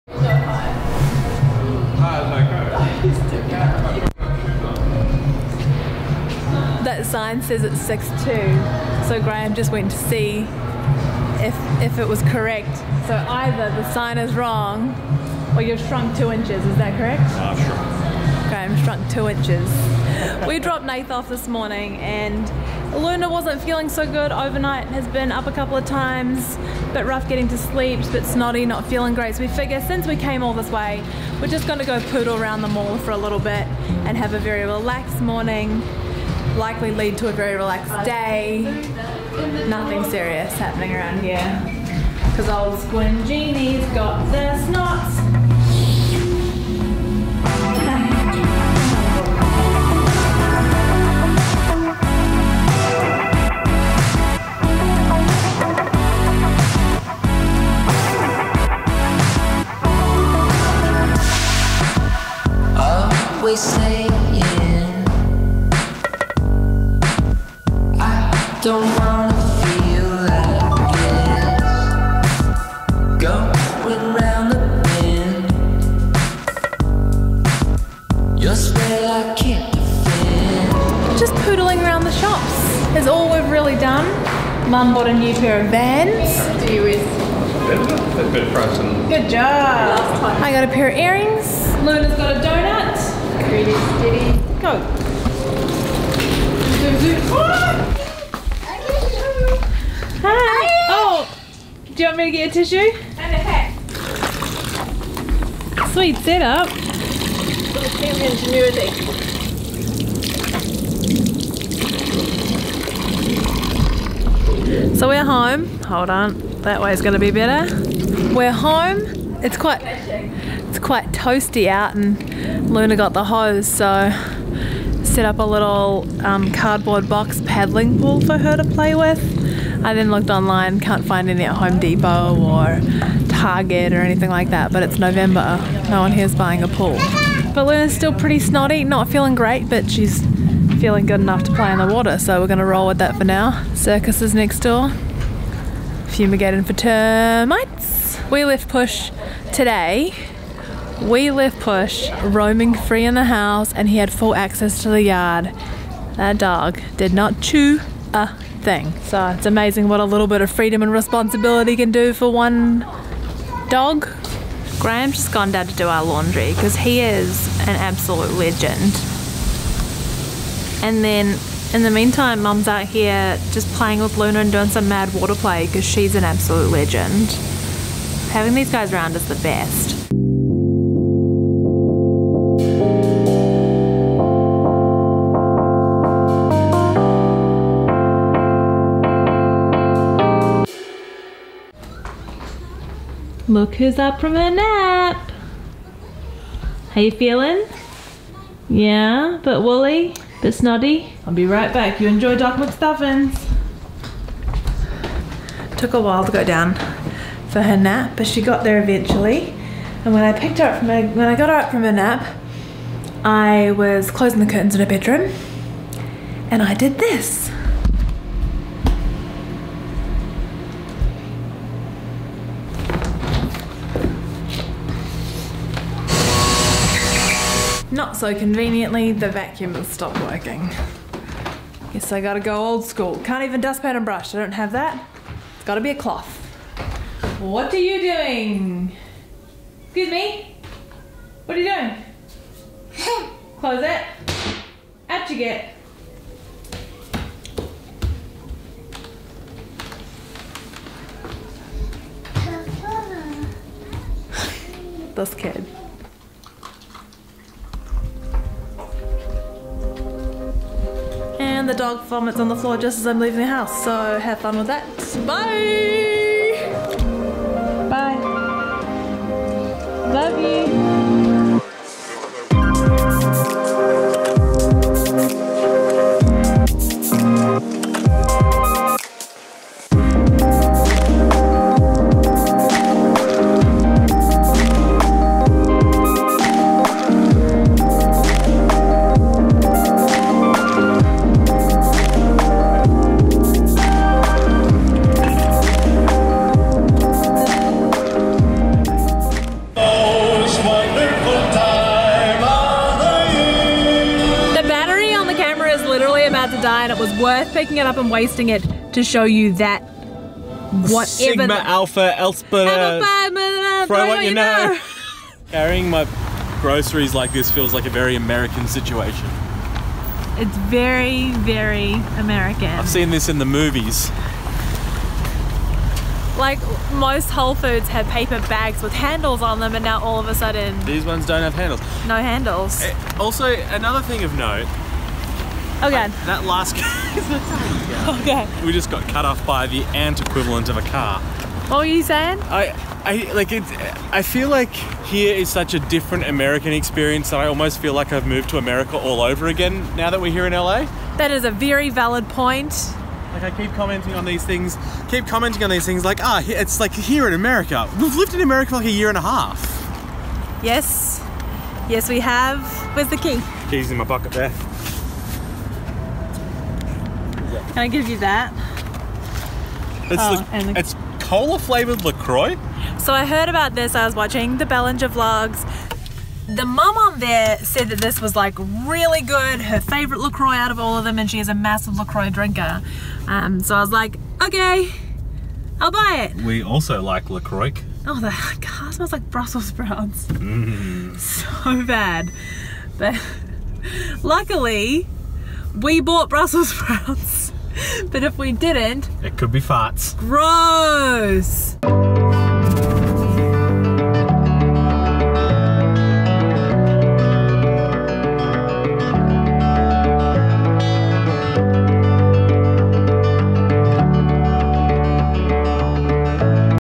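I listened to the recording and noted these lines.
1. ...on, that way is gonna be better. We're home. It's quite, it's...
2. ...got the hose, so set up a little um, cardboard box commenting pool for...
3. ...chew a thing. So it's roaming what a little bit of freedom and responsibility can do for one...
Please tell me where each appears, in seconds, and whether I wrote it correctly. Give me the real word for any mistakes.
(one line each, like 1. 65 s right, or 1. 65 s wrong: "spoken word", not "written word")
1. 116 s right
2. 122 s wrong: "paddling", not "commenting"
3. 157 s wrong: "amazing", not "roaming".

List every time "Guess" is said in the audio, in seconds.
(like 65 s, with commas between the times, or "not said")
231 s.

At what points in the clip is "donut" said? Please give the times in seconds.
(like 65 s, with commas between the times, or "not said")
92 s.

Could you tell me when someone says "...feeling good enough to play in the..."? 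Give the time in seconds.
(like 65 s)
140 s.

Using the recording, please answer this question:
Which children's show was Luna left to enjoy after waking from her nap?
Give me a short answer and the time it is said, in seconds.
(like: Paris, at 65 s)
Doc McStuffins, at 202 s.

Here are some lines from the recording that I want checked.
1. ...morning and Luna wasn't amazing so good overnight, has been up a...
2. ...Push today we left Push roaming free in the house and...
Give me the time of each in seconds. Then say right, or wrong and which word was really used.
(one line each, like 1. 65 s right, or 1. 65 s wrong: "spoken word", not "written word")
1. 21 s wrong: "feeling", not "amazing"
2. 148 s right.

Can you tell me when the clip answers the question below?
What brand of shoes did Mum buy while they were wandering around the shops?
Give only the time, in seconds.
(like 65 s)
85 s.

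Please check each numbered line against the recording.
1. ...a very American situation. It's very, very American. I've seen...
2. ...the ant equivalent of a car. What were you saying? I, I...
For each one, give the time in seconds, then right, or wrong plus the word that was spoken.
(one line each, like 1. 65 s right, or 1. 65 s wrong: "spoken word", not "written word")
1. 317 s right
2. 339 s right.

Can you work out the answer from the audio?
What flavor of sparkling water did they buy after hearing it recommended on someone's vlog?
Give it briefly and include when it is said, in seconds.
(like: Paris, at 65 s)
Cola, at 371 s.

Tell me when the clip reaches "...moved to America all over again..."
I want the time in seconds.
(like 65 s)
348 s.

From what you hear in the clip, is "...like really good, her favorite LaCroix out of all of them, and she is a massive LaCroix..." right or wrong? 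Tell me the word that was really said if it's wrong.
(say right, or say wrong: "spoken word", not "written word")
right.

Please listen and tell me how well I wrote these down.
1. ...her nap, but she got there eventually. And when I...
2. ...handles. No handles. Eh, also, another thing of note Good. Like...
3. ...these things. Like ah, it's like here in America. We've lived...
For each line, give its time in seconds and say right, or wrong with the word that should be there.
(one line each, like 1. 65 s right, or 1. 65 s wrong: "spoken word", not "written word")
1. 207 s right
2. 331 s wrong: "Okay", not "Good"
3. 355 s right.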